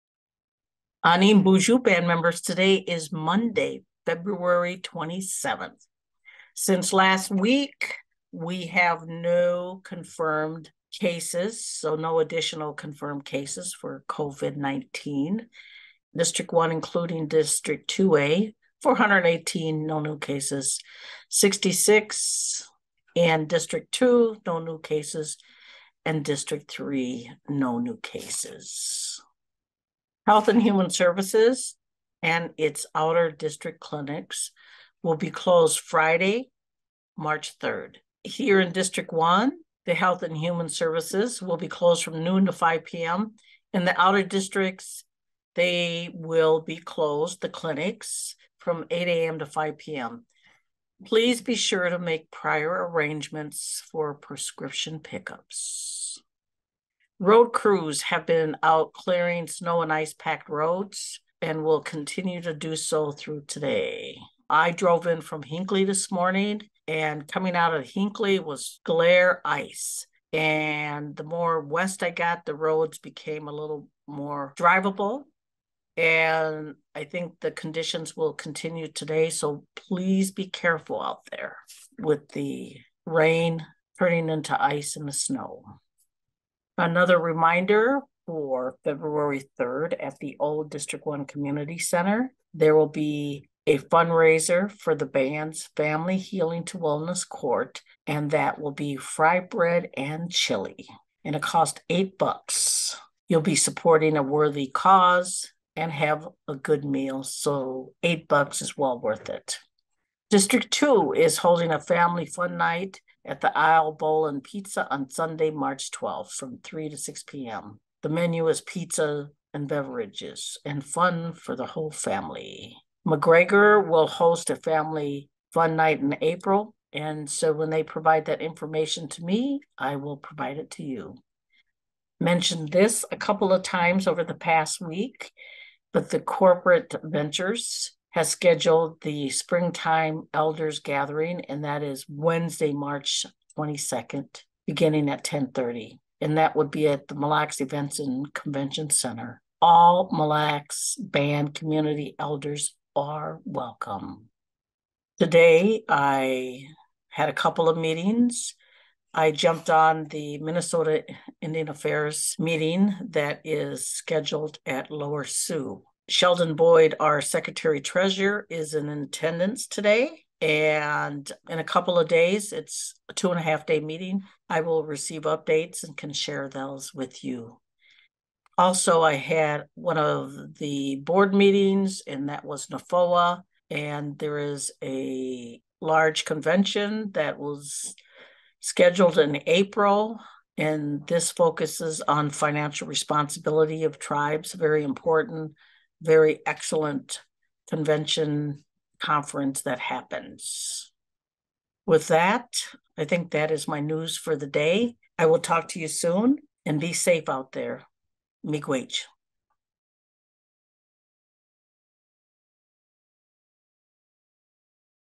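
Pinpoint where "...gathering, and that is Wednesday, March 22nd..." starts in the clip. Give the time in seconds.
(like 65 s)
140 s.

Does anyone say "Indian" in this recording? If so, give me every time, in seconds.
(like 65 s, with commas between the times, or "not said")
161 s.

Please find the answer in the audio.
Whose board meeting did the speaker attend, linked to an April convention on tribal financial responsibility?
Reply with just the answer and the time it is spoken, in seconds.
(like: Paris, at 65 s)
NAFOA, at 182 s.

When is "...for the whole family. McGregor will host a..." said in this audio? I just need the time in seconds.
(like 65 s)
121 s.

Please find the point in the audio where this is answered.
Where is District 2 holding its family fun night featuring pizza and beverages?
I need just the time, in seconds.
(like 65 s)
113 s.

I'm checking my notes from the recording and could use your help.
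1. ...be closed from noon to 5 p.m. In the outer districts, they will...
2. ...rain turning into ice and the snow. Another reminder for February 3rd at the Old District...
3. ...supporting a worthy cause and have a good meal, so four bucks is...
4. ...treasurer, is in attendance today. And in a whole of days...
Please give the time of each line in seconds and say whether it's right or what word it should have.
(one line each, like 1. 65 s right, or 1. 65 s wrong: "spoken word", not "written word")
1. 41 s right
2. 83 s right
3. 103 s wrong: "eight", not "four"
4. 167 s wrong: "couple", not "whole".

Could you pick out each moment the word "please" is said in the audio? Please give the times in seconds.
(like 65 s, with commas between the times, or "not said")
51 s, 79 s.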